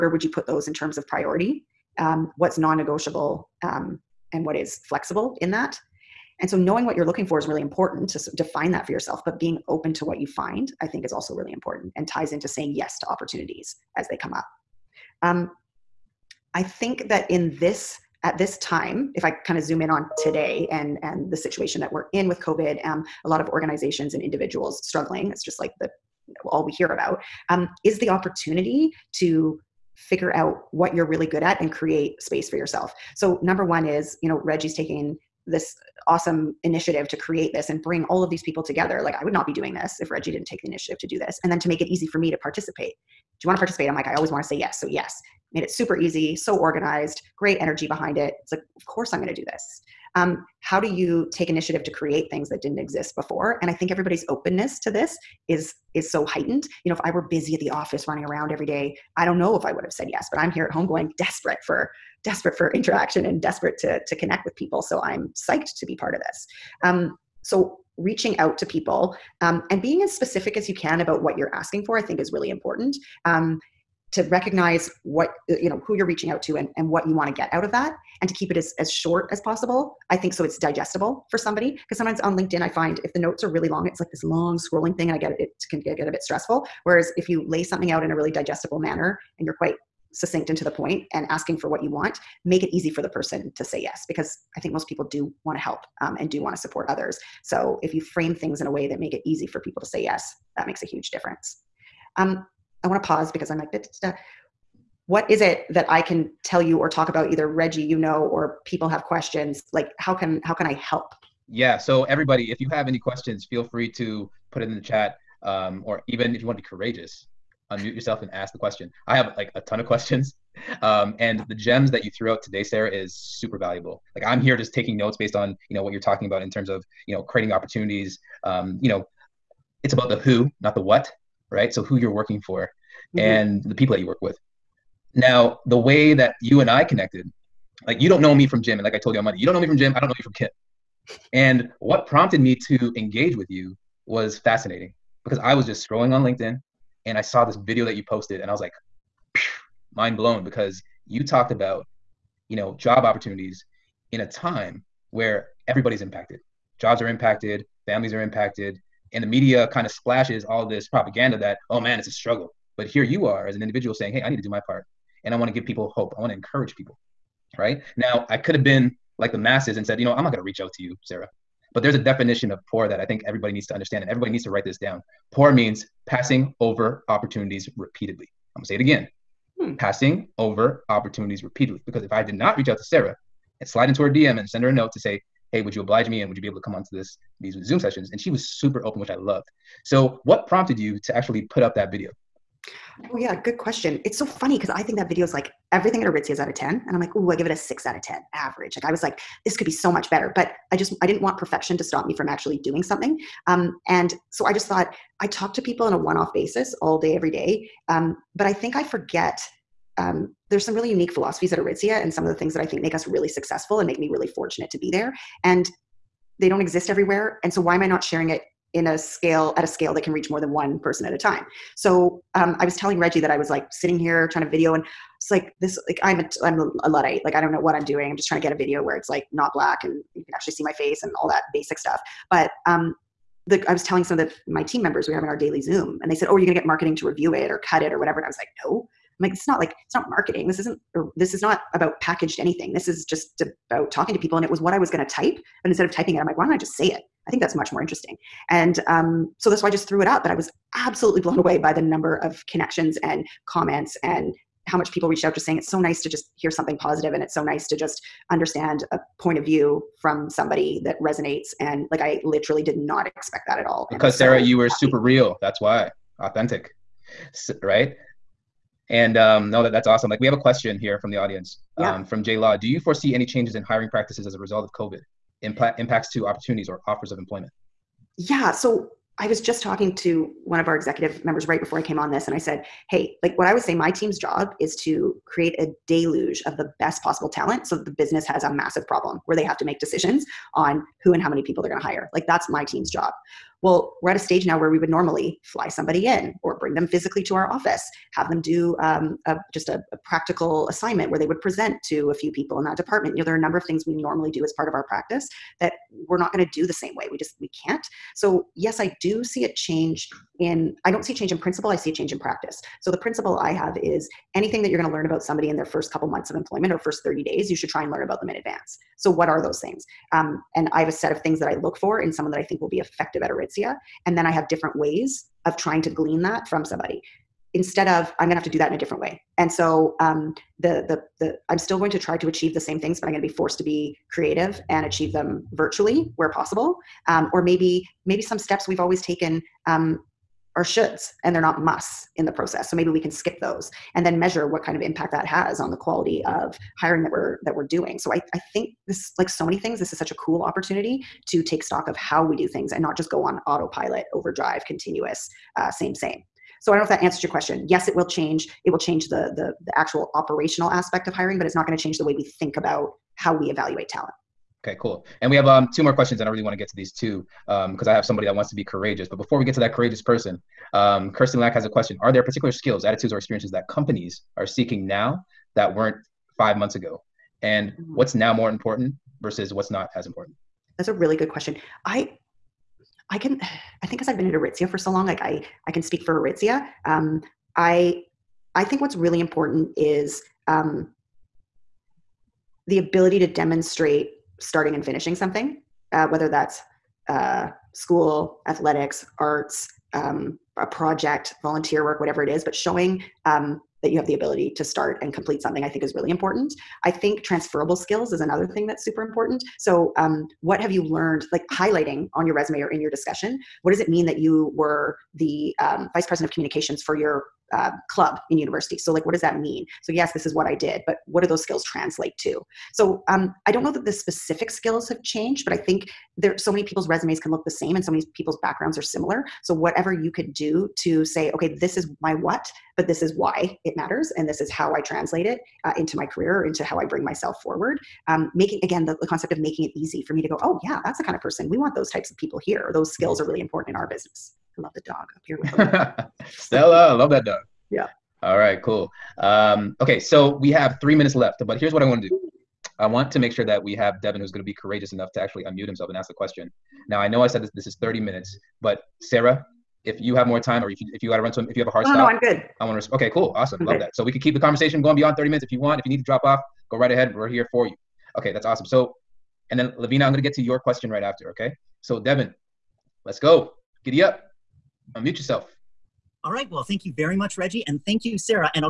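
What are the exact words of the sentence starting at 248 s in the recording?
And um, so that's why I just threw it up.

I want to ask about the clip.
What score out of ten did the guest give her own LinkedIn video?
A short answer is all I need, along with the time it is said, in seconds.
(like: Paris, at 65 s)
6, at 197 s.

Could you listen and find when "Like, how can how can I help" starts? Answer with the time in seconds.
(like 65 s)
109 s.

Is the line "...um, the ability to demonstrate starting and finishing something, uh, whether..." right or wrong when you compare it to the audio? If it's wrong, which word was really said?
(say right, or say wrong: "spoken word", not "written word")
right.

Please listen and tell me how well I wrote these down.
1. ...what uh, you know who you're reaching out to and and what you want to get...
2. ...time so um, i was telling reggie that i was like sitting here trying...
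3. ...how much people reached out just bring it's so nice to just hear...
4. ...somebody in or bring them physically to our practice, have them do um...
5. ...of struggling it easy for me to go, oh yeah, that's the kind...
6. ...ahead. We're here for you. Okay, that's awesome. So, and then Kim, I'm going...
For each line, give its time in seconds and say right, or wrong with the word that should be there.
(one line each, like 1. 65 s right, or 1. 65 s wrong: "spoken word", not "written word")
1. 75 s right
2. 221 s right
3. 254 s wrong: "saying", not "bring"
4. 295 s wrong: "office", not "practice"
5. 439 s wrong: "making", not "struggling"
6. 466 s wrong: "Lavina", not "Kim".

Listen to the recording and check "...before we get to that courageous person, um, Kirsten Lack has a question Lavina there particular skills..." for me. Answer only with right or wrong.
wrong.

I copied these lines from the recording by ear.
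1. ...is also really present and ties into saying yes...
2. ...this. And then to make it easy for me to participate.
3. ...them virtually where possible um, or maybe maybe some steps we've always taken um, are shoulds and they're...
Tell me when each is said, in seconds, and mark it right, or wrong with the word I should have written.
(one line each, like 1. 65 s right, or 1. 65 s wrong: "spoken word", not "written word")
1. 11 s wrong: "important", not "present"
2. 41 s right
3. 335 s right.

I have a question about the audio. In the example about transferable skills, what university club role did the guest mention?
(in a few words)
Vice president of communications.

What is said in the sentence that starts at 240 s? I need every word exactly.
This isn't or this is not about packaged anything.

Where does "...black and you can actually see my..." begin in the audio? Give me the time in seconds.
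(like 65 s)
229 s.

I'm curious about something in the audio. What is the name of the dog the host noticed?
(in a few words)
Stella.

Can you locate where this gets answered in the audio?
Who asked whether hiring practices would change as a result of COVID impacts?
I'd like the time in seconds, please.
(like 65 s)
272 s.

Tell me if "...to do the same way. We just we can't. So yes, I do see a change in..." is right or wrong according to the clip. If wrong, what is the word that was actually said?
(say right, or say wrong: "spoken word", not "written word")
right.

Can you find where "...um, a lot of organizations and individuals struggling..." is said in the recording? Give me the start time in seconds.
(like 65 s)
22 s.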